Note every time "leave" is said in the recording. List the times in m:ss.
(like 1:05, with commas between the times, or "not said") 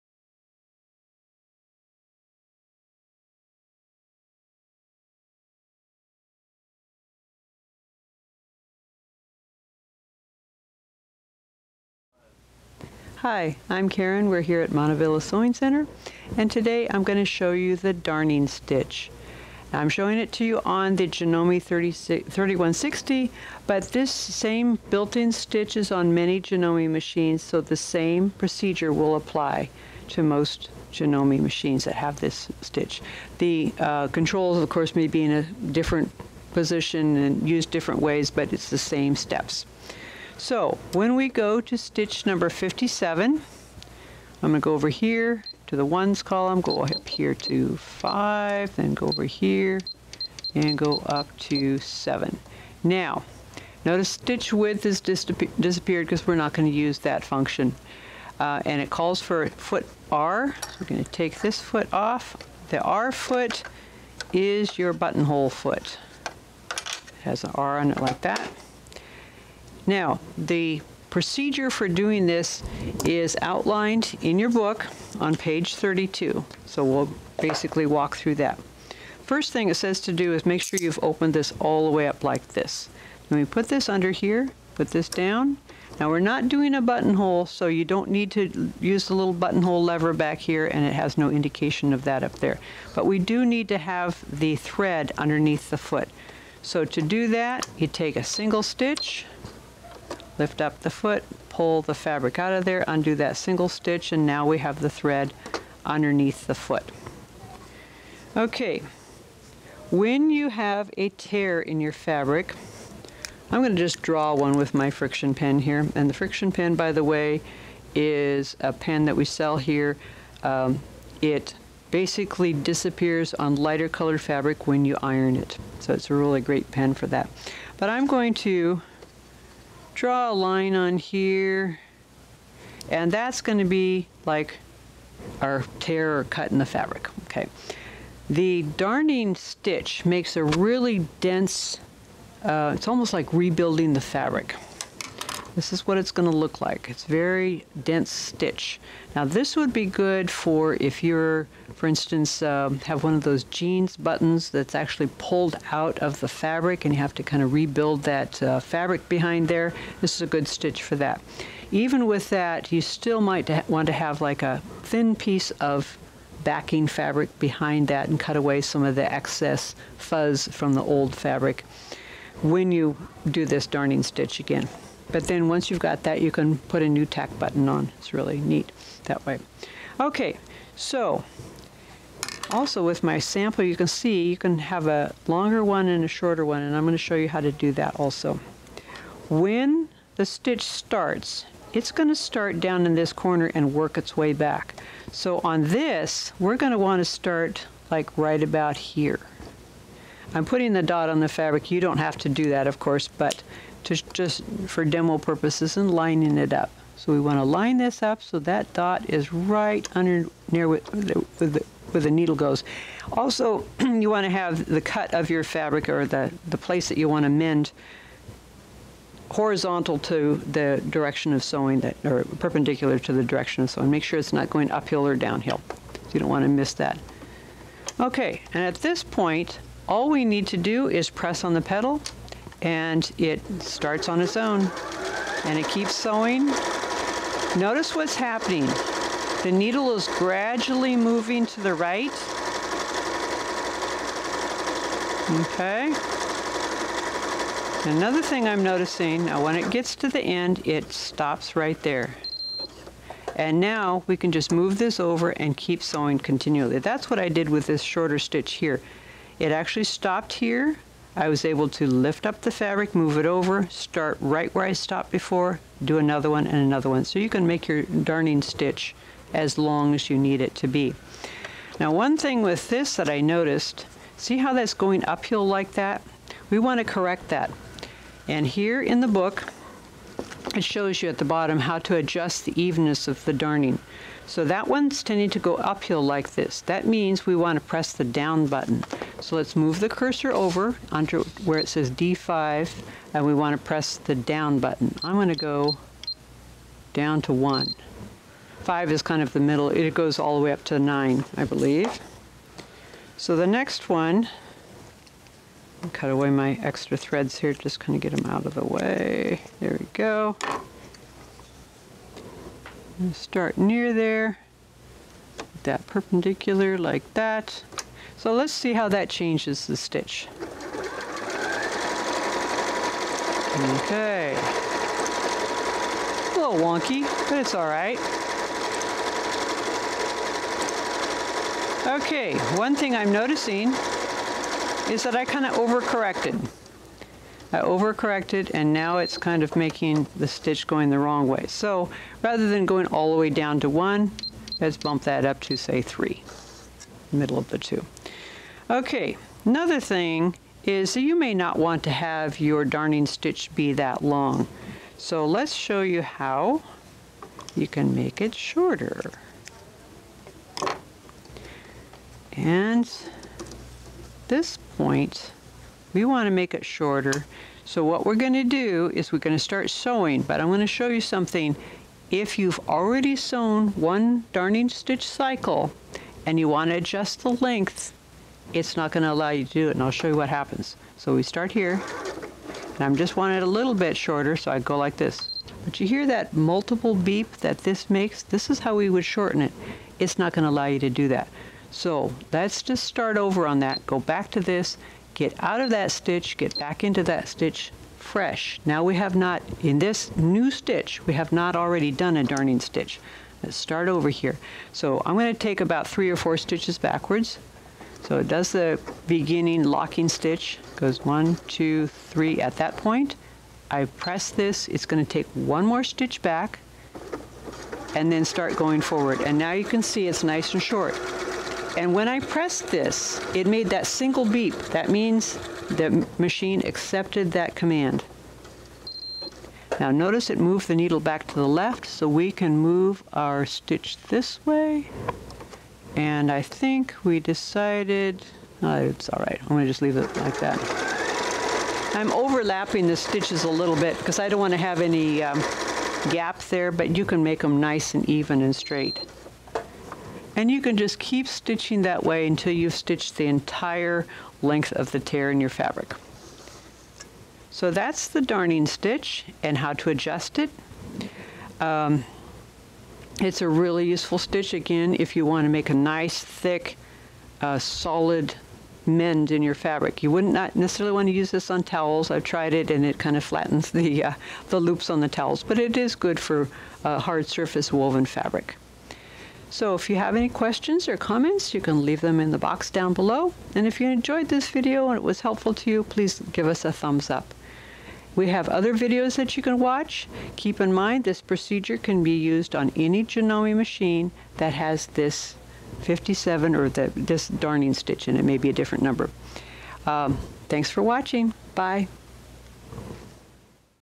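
7:19, 8:01.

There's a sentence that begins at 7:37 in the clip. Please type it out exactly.
So that's the darning stitch and how to adjust it.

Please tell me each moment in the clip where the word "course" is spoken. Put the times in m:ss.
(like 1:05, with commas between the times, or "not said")
0:34, 3:22.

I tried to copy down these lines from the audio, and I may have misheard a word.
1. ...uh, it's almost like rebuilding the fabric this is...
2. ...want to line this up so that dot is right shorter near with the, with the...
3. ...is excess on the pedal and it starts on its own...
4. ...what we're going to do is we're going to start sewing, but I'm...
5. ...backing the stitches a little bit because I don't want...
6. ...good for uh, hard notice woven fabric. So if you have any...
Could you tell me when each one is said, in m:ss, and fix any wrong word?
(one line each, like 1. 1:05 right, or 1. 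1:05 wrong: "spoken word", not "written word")
1. 2:22 right
2. 3:27 wrong: "under", not "shorter"
3. 3:50 wrong: "press", not "excess"
4. 6:07 right
5. 7:22 wrong: "overlapping", not "backing"
6. 7:55 wrong: "surface", not "notice".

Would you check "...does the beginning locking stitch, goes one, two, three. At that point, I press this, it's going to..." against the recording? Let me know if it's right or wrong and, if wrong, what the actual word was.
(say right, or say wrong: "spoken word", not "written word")
right.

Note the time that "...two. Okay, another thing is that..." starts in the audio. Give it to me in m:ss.
5:47.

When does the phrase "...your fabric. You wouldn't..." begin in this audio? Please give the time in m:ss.
7:49.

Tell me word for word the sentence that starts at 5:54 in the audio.
So let's show you how you can make it shorter.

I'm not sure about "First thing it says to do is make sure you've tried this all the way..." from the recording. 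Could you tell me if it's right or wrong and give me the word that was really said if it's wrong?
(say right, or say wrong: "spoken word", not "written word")
wrong: "opened", not "tried".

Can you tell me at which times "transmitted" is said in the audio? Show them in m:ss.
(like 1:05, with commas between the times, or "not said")
not said.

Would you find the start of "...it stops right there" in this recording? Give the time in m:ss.
4:10.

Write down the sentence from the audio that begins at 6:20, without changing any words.
So we start here, and I'm just wanting it a little bit shorter, so I go like this.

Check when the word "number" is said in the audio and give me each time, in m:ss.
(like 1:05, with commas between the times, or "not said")
0:42, 8:18.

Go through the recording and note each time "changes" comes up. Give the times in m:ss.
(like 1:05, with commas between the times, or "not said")
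5:19.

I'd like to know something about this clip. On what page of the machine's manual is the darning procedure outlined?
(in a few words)
32.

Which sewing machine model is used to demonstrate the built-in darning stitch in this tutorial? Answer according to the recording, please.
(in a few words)
Janome 3160.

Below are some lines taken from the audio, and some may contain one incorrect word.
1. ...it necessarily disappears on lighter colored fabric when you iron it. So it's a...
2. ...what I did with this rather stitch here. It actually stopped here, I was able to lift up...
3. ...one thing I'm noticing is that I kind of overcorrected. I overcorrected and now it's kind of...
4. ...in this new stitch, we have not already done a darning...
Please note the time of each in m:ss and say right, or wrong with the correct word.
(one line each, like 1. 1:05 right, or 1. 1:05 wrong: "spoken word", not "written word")
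1. 2:01 wrong: "basically", not "necessarily"
2. 4:17 wrong: "shorter", not "rather"
3. 5:32 right
4. 6:39 right.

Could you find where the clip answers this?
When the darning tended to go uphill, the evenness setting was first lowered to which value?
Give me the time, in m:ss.
4:57.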